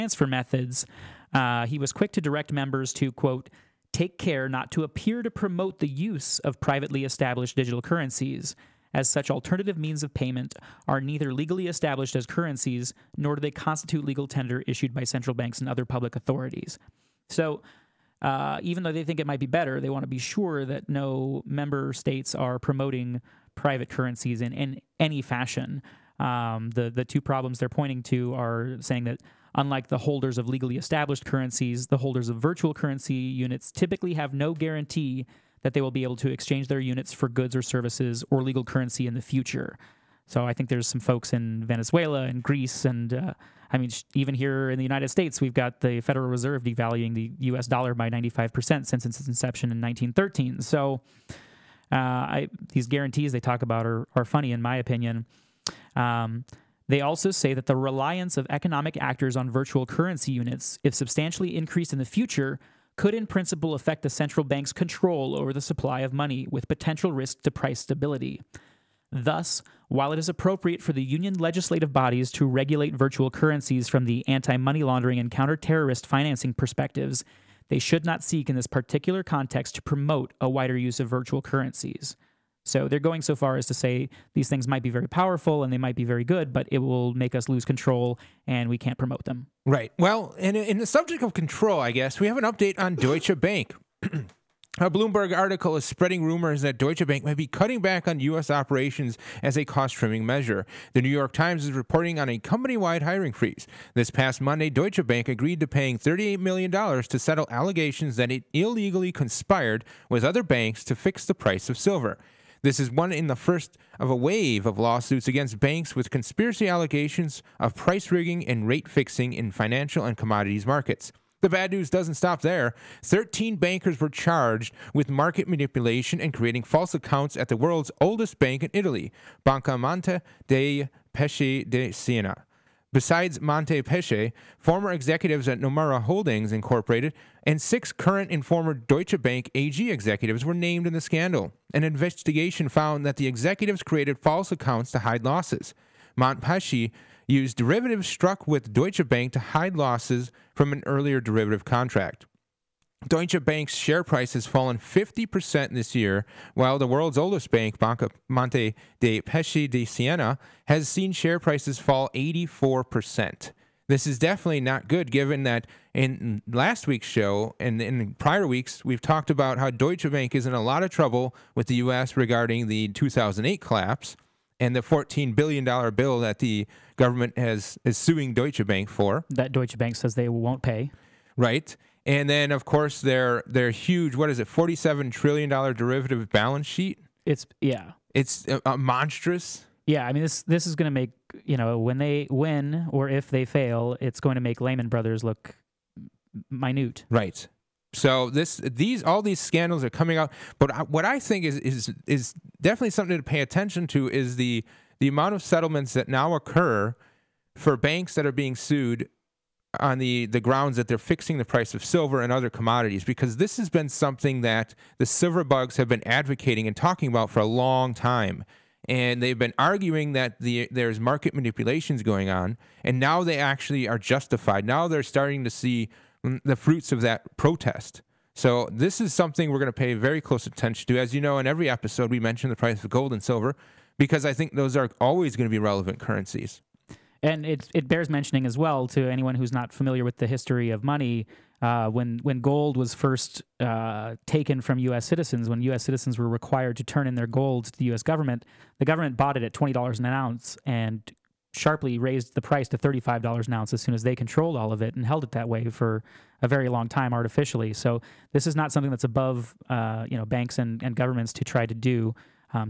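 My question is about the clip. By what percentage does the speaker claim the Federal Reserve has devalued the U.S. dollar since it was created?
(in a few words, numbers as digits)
95%.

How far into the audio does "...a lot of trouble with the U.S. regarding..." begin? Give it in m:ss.
2:50.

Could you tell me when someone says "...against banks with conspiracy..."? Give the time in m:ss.
1:55.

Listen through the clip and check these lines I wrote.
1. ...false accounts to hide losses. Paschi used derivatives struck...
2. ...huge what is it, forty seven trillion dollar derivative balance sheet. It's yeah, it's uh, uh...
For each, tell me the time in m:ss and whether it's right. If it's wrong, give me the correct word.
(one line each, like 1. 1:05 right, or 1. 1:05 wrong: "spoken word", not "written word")
1. 2:24 right
2. 3:03 right.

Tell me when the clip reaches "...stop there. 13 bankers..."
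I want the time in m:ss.
2:02.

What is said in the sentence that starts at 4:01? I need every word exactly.
Uh, when when gold was first uh, taken from U.S.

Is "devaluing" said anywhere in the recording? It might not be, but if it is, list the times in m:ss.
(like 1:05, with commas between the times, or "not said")
0:46.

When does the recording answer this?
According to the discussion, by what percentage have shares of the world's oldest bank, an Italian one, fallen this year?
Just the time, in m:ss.
2:42.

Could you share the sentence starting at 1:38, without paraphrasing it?
operations as a cost trimming measure.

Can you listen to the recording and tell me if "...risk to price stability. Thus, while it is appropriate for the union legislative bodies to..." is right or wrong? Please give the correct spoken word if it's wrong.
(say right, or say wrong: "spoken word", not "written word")
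right.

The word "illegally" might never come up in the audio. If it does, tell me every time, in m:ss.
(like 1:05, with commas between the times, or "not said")
1:48.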